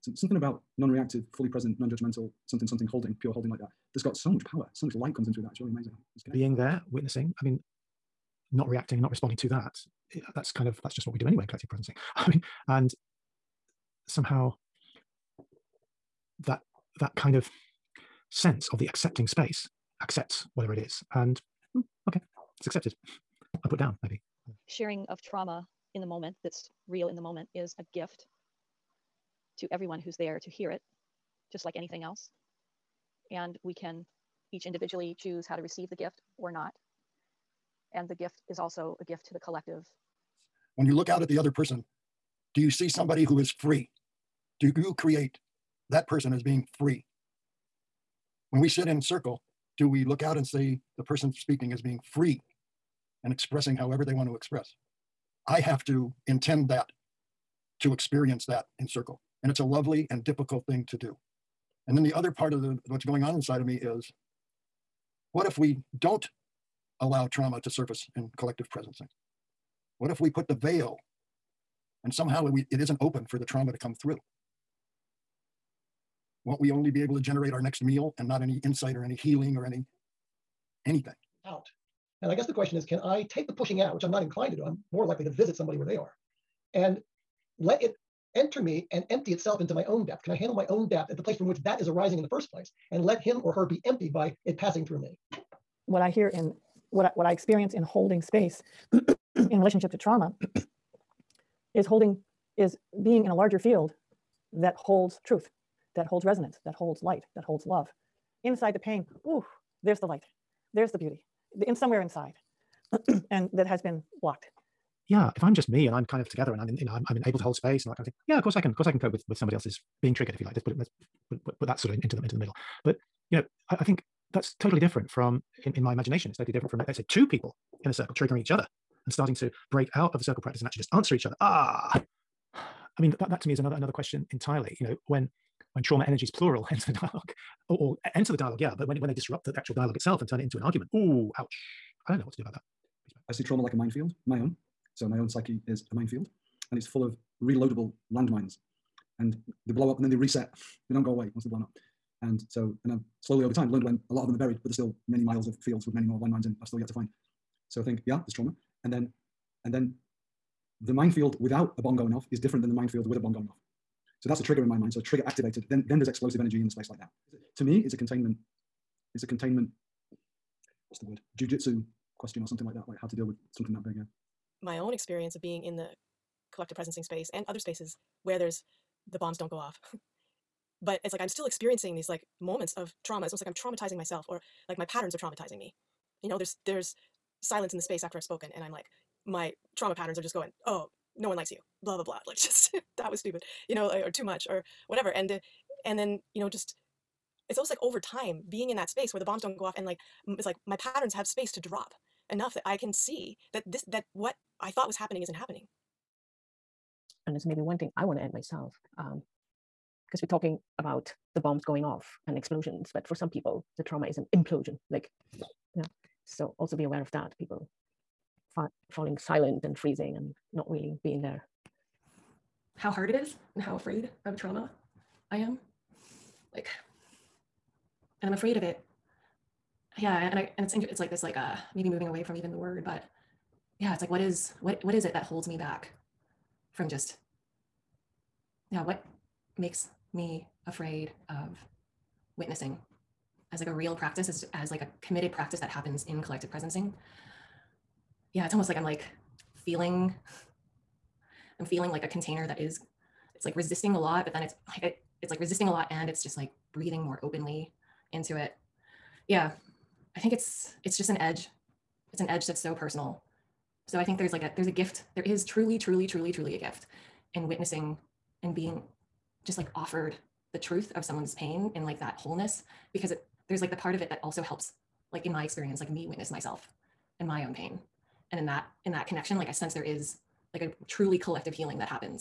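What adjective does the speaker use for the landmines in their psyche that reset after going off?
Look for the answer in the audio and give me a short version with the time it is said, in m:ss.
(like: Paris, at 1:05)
reloadable, at 2:27.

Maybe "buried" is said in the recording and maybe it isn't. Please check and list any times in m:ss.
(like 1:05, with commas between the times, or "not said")
2:34.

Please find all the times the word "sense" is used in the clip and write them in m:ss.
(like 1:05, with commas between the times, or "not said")
0:18, 4:39.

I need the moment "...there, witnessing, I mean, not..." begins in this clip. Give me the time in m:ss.
0:06.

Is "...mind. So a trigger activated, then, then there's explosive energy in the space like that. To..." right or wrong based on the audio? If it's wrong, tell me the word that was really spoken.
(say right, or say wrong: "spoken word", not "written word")
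right.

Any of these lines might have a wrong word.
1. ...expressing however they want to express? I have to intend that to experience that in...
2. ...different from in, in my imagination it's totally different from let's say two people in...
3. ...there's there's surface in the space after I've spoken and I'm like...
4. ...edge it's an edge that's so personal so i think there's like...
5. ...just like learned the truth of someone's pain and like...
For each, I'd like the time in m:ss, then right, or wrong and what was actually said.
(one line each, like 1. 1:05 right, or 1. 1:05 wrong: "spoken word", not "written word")
1. 0:53 right
2. 2:04 right
3. 3:06 wrong: "silence", not "surface"
4. 4:21 right
5. 4:29 wrong: "offered", not "learned".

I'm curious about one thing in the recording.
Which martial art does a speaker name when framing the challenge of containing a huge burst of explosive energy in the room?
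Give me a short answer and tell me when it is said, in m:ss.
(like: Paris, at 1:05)
Jujitsu, at 2:51.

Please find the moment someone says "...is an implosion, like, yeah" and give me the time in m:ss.
3:34.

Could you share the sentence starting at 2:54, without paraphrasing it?
My own experience of being in the collective presencing space and other spaces where there's the bombs don't go off.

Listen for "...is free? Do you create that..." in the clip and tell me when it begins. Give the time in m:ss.
0:43.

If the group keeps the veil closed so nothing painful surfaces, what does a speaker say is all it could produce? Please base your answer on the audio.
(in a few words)
next meal.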